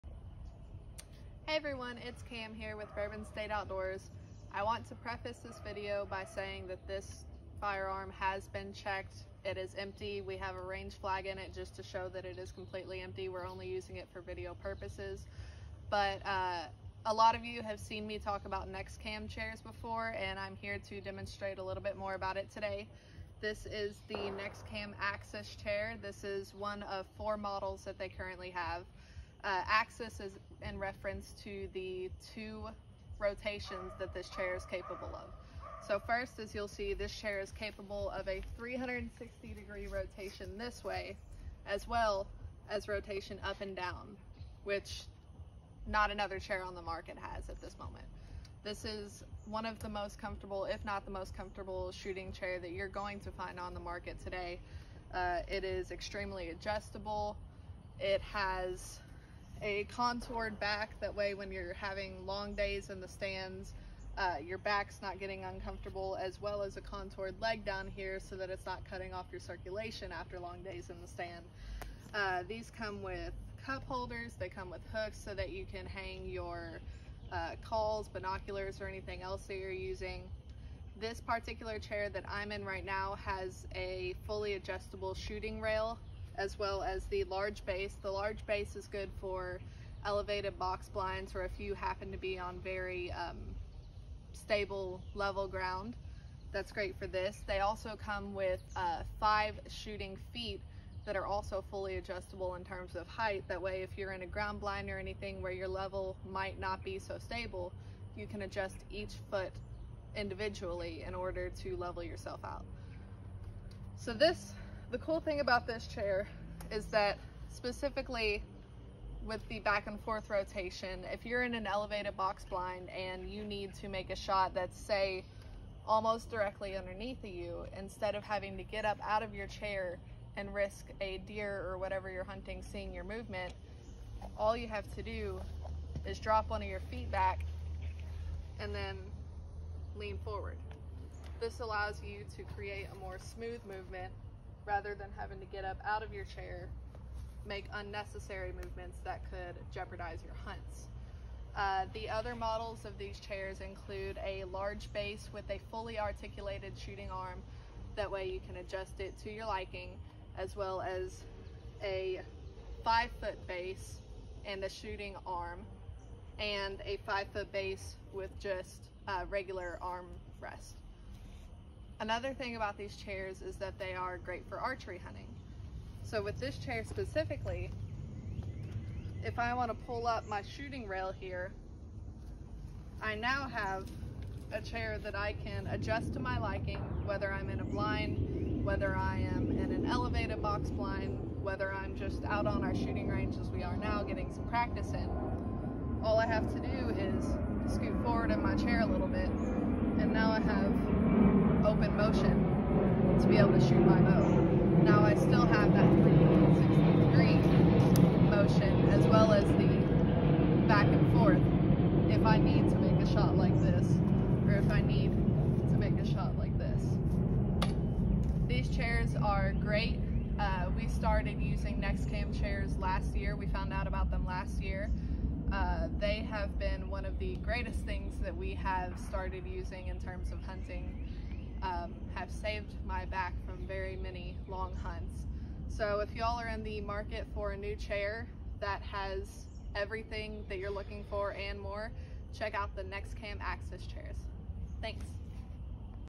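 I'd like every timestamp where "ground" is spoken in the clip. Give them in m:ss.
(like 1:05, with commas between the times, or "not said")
1:35, 1:44.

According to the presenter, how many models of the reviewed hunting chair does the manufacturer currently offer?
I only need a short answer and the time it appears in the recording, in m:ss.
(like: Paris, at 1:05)
4, at 0:27.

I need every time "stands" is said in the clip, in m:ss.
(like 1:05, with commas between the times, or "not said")
1:03, 1:11.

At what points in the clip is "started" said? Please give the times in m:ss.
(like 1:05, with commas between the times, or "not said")
3:40, 3:48.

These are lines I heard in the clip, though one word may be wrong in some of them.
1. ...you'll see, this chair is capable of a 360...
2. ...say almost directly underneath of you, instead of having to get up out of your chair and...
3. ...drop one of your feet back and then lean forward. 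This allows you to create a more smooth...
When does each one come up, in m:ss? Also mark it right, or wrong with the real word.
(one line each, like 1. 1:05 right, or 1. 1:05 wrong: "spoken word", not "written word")
1. 0:36 right
2. 2:04 right
3. 2:16 right.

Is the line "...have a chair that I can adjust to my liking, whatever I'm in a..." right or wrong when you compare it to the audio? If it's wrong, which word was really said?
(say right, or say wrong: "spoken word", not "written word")
wrong: "whether", not "whatever".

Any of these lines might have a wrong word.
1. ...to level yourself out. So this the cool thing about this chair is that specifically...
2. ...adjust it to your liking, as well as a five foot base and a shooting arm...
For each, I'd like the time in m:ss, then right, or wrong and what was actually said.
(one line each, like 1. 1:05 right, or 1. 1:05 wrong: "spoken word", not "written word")
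1. 1:51 right
2. 2:38 right.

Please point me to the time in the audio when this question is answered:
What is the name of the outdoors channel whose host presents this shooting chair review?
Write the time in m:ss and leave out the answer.
0:02.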